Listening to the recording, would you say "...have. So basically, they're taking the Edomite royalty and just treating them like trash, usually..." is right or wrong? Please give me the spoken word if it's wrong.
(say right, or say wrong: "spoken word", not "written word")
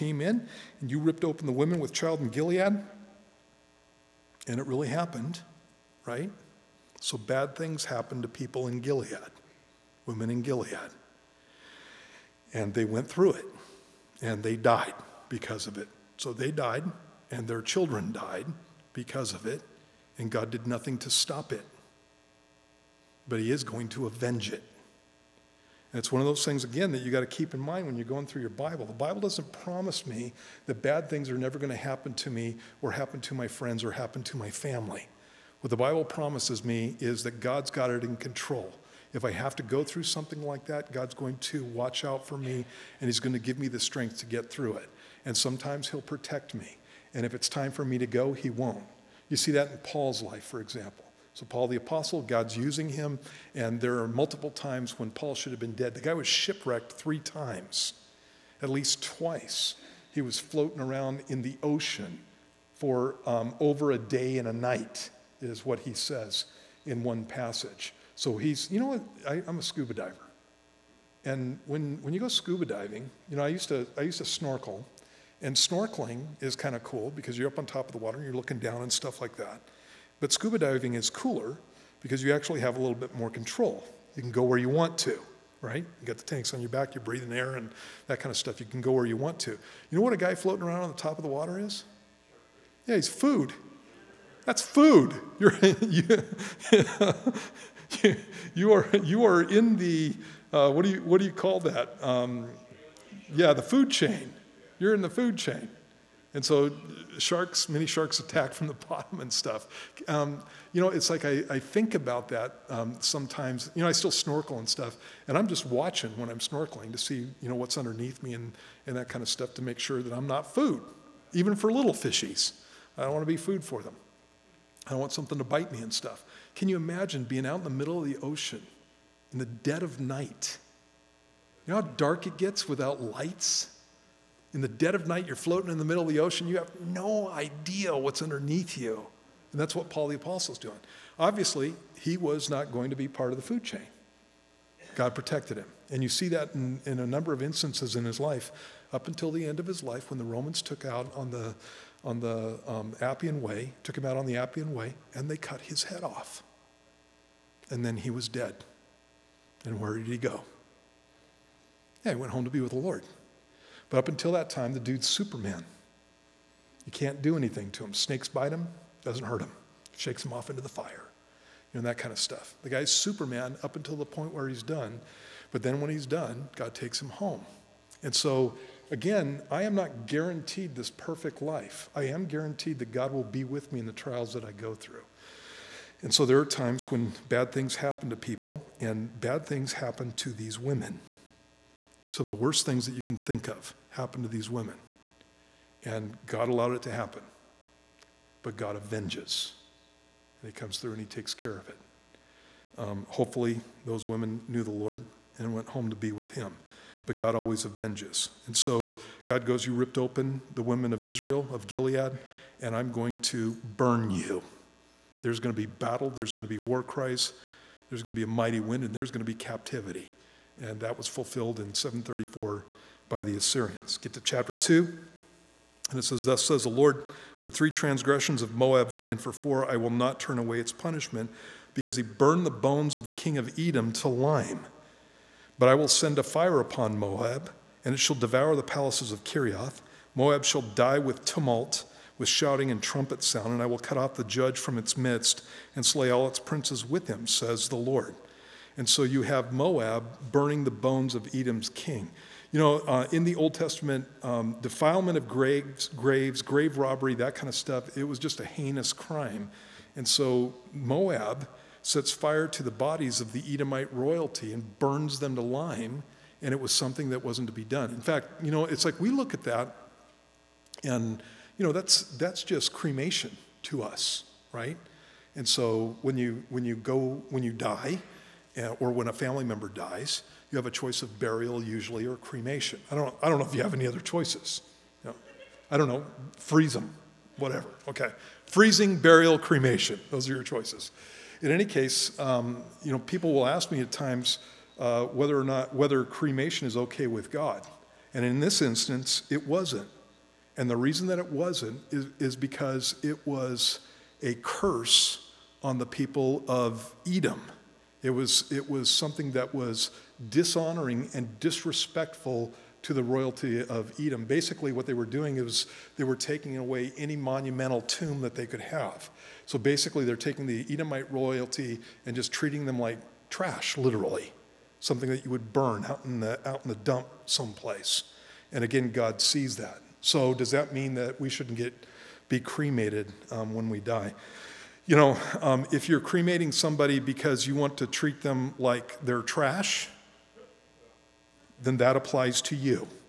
wrong: "literally", not "usually".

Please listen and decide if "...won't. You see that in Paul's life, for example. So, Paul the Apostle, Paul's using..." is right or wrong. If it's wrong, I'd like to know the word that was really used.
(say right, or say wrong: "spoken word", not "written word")
wrong: "God", not "Paul".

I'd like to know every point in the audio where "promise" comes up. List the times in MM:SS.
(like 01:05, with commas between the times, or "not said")
00:29, 00:36.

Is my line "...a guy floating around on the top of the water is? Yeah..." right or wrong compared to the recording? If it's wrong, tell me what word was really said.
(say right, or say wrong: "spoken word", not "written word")
right.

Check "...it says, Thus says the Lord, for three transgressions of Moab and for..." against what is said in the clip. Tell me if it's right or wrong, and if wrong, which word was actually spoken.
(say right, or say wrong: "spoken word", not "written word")
right.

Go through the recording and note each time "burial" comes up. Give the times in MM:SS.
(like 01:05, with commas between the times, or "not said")
04:41, 04:48.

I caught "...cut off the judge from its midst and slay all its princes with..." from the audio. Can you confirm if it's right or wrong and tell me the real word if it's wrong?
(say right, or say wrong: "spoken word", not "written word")
right.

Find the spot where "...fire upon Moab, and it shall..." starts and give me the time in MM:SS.
03:56.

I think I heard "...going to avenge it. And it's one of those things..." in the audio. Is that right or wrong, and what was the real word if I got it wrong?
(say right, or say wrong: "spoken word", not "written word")
right.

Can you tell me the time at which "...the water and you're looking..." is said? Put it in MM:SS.
01:17.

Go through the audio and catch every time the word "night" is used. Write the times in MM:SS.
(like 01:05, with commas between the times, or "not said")
01:04, 02:09, 02:15.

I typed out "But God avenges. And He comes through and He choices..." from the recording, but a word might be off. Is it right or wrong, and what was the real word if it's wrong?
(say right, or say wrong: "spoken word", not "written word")
wrong: "takes", not "choices".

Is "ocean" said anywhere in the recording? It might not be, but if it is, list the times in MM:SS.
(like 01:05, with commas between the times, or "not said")
01:01, 02:08, 02:16.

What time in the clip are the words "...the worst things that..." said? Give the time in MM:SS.
03:12.